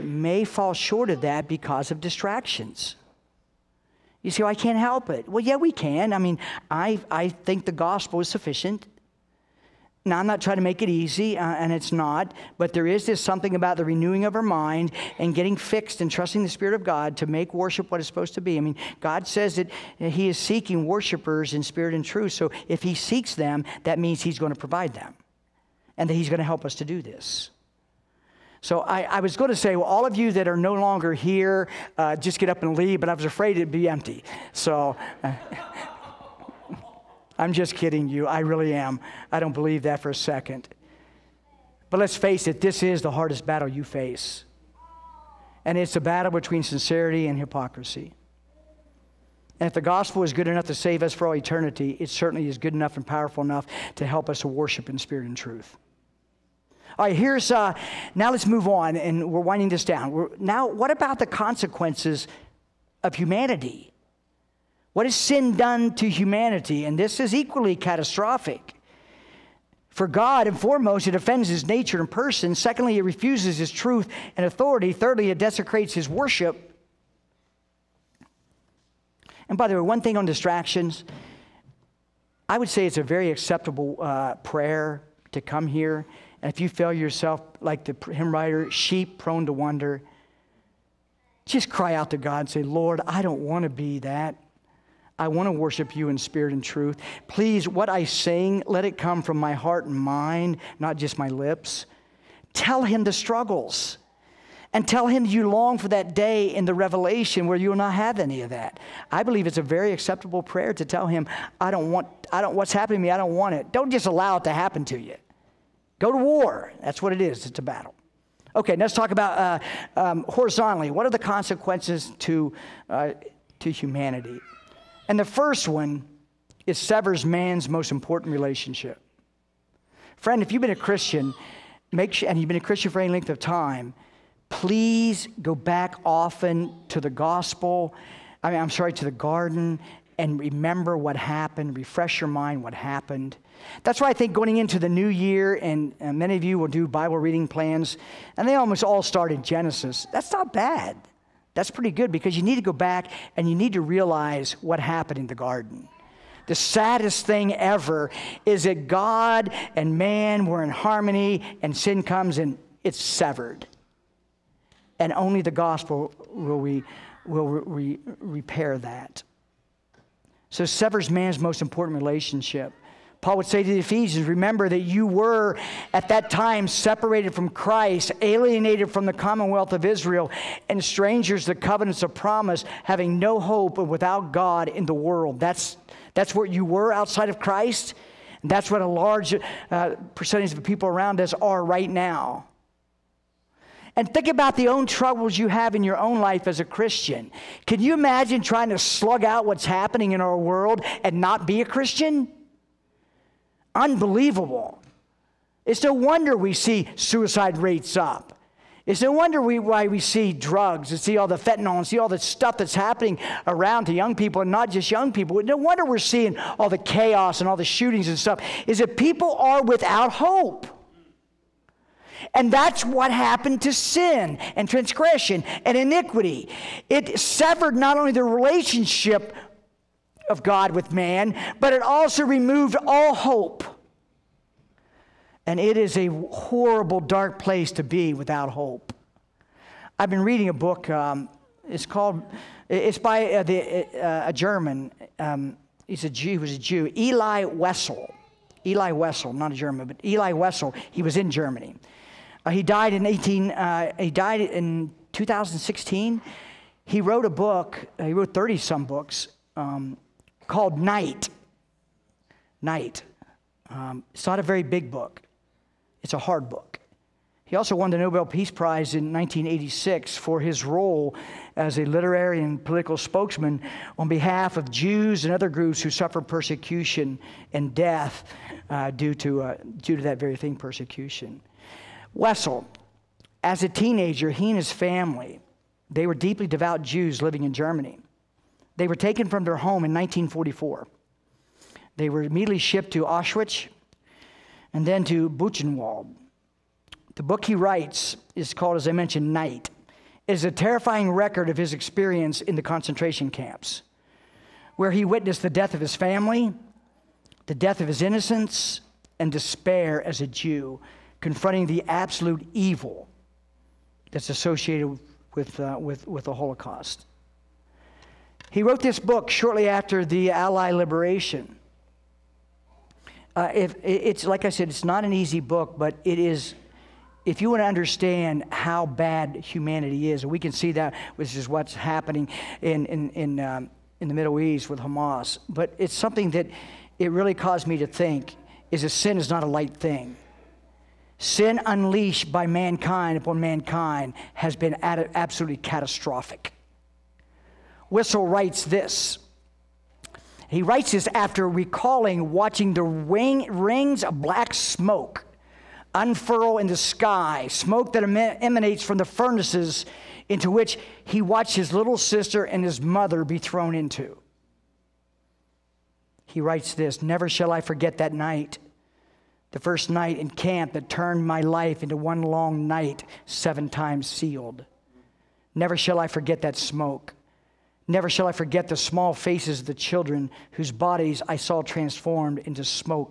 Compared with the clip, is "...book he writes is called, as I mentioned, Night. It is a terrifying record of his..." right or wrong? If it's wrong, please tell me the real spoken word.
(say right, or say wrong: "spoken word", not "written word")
right.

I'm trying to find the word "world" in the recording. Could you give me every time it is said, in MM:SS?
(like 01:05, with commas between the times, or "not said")
03:04, 03:20.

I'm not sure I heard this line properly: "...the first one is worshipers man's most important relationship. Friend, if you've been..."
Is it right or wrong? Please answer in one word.
wrong.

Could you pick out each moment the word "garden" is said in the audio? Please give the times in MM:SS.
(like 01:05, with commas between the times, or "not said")
02:19, 02:35.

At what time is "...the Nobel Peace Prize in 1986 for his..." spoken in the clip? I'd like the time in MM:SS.
04:27.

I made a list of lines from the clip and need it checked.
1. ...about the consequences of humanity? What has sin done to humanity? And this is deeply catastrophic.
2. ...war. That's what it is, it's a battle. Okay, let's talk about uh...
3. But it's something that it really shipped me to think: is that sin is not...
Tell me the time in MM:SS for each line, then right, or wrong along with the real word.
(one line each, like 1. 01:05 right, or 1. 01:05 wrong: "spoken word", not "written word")
1. 01:00 wrong: "equally", not "deeply"
2. 01:56 right
3. 05:35 wrong: "caused", not "shipped".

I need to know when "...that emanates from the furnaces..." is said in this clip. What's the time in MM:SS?
05:57.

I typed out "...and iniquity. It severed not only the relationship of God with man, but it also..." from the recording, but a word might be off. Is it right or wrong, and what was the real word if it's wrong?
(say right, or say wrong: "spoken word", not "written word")
right.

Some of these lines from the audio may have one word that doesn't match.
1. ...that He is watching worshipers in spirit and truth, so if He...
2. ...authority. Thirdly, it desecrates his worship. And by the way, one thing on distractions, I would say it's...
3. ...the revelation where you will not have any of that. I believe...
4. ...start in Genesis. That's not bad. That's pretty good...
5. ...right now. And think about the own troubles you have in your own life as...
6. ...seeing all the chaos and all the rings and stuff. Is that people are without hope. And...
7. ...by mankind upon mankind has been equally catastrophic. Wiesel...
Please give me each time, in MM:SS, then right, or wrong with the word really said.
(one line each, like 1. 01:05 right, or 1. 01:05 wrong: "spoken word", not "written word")
1. 00:19 wrong: "seeking", not "watching"
2. 01:14 right
3. 01:46 right
4. 02:29 right
5. 03:11 right
6. 03:35 wrong: "shootings", not "rings"
7. 05:42 wrong: "absolutely", not "equally".